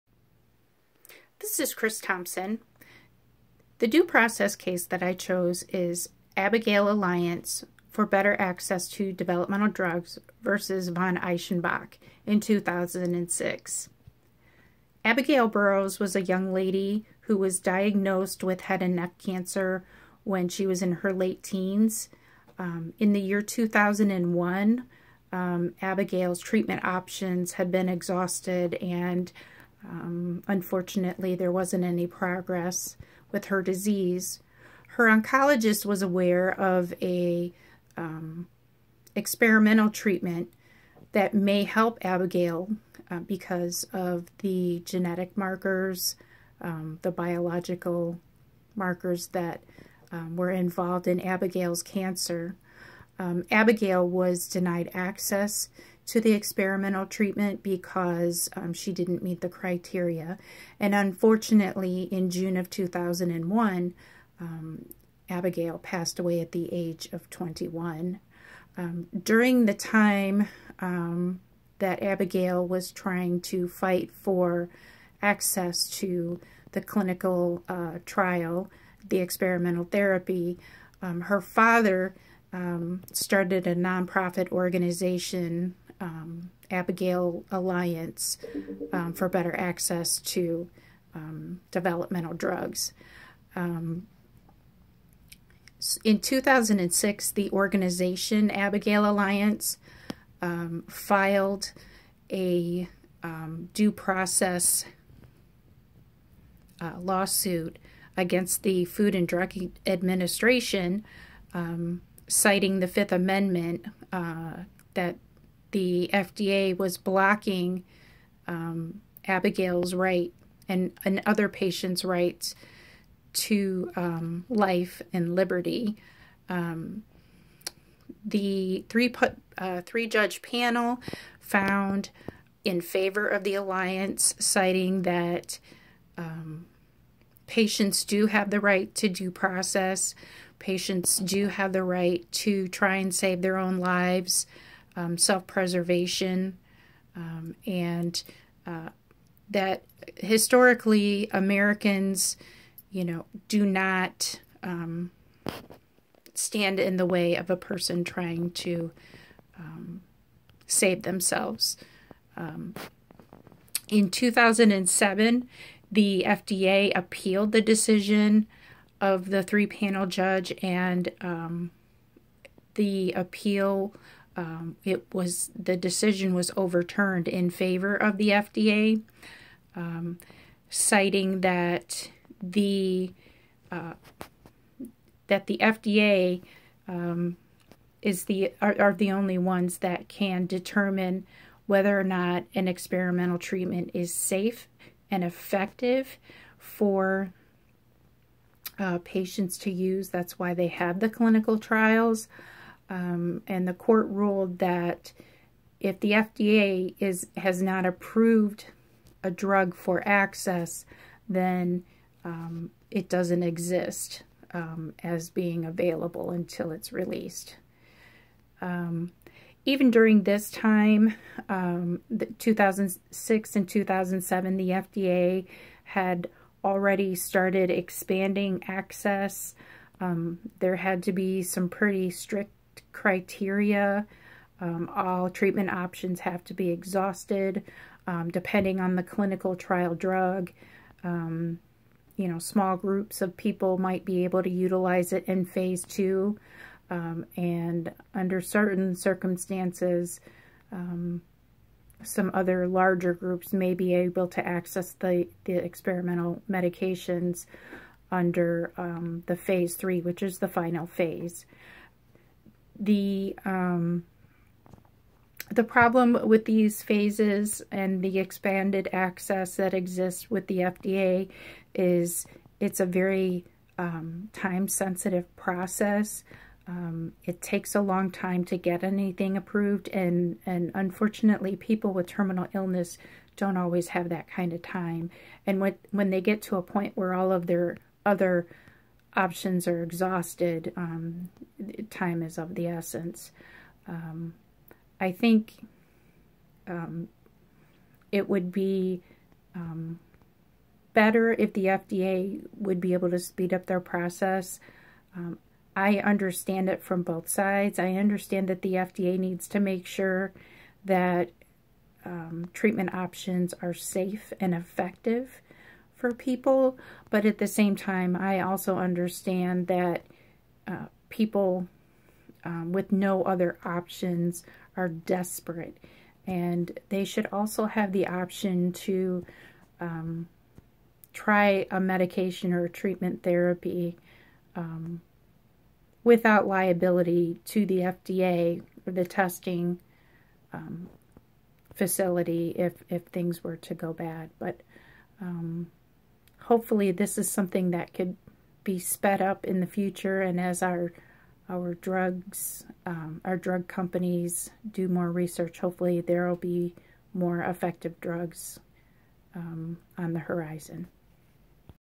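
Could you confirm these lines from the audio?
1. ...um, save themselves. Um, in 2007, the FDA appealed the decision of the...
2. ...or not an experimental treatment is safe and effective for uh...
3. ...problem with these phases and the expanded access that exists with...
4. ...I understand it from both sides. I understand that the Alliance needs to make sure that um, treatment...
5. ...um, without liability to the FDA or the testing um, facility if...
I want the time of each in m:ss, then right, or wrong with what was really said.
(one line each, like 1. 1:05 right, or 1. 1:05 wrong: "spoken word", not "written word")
1. 2:39 right
2. 3:11 right
3. 4:25 right
4. 5:05 wrong: "FDA", not "Alliance"
5. 5:34 right.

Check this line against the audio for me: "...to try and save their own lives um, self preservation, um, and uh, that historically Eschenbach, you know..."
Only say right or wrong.
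wrong.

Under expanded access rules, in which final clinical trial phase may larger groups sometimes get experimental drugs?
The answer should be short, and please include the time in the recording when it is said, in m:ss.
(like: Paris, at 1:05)
Phase three, at 4:19.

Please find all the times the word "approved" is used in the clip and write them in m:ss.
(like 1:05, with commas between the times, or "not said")
3:27, 4:39.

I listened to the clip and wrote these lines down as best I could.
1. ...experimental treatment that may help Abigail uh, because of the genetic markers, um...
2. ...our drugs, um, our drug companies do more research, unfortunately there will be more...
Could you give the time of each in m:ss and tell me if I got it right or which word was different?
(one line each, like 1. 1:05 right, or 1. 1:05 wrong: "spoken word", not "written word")
1. 0:39 right
2. 5:51 wrong: "hopefully", not "unfortunately".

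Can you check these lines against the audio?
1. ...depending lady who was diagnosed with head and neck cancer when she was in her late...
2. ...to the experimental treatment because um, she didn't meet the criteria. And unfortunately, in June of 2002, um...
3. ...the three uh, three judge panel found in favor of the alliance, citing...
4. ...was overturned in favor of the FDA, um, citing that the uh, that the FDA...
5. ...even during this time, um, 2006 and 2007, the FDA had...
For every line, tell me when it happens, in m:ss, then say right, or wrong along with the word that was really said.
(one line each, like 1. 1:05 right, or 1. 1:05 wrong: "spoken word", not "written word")
1. 0:16 wrong: "young", not "depending"
2. 0:56 wrong: "2001", not "2002"
3. 2:08 right
4. 2:56 right
5. 3:39 right.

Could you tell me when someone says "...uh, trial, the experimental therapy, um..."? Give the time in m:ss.
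1:17.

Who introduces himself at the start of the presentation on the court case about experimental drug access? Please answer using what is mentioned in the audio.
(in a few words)
Kriss Thompson.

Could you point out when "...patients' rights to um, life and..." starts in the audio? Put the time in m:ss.
2:01.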